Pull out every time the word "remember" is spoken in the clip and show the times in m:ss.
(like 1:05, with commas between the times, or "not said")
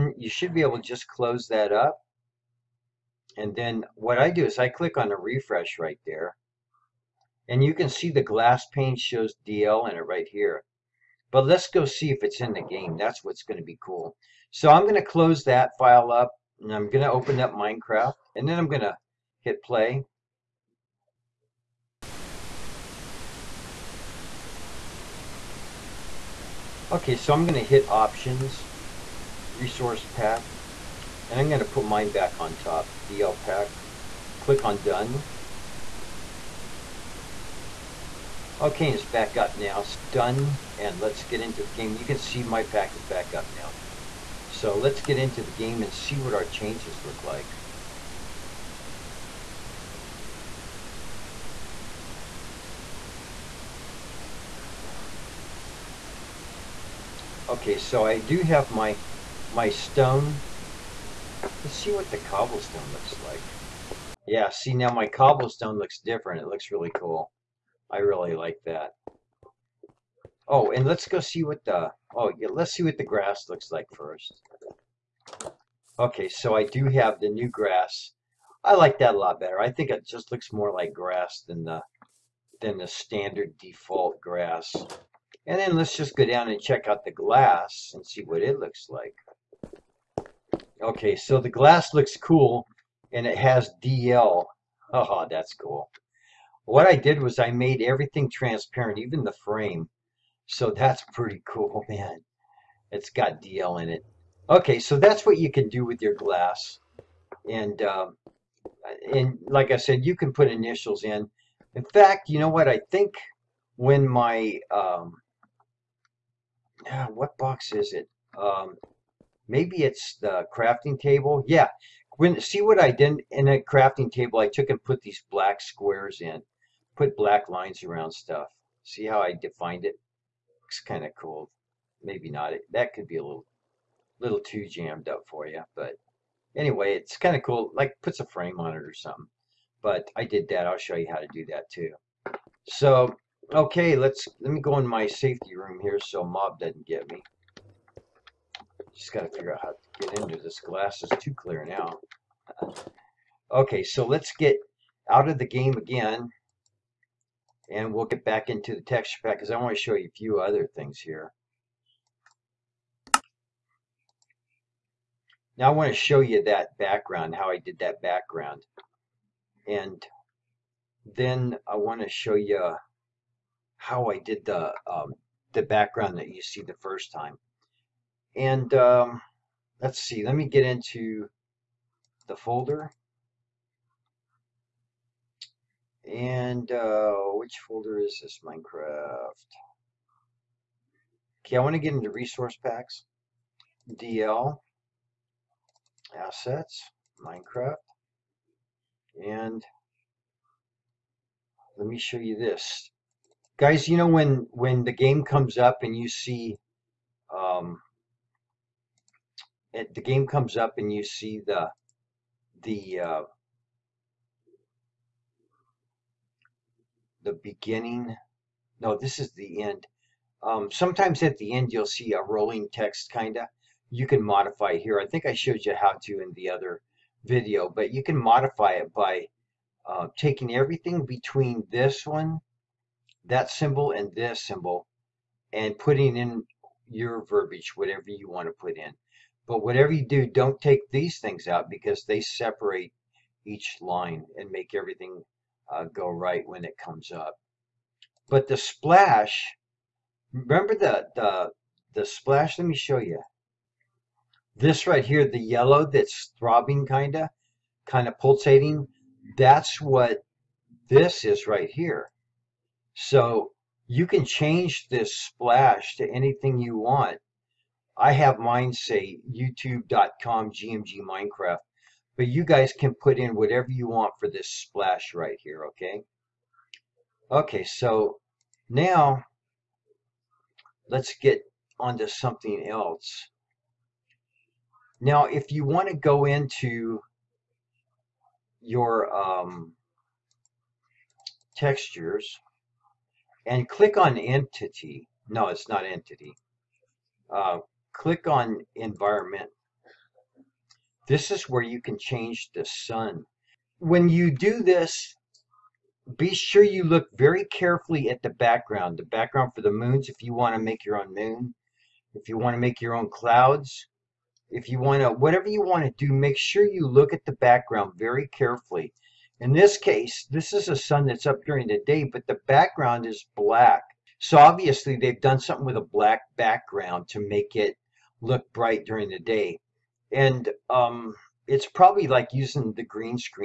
4:10.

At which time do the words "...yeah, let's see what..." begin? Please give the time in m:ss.
1:12.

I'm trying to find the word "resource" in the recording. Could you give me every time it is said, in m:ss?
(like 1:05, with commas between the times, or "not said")
0:29, 3:12.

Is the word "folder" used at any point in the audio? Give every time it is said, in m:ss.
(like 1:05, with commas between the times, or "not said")
3:02, 3:07.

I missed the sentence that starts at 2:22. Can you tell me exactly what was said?
So okay, let's let me go in my safety room here so mob doesn't get me.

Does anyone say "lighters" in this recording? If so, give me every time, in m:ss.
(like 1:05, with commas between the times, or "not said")
not said.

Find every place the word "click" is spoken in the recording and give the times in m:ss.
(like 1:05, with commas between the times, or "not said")
0:04, 0:34, 4:53, 4:57.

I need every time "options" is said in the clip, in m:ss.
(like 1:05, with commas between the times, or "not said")
0:27.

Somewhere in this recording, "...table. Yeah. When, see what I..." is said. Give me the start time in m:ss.
2:00.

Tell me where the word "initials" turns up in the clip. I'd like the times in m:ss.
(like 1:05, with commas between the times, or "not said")
1:50.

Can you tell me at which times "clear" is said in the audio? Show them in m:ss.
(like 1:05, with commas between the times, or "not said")
2:31.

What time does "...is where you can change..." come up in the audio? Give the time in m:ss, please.
5:01.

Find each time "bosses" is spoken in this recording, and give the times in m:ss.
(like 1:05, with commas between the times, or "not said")
not said.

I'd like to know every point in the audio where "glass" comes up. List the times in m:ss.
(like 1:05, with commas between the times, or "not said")
0:08, 1:27, 1:31, 1:46, 2:30.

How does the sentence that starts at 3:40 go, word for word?
Um, sometimes at the end you'll see a rolling text kind of.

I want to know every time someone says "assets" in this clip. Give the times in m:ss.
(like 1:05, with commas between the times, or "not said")
3:16.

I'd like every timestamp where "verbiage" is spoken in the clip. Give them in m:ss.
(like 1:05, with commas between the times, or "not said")
3:57.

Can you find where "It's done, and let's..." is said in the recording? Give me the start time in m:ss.
0:39.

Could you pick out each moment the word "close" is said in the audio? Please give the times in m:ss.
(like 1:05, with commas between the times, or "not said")
0:01, 0:15.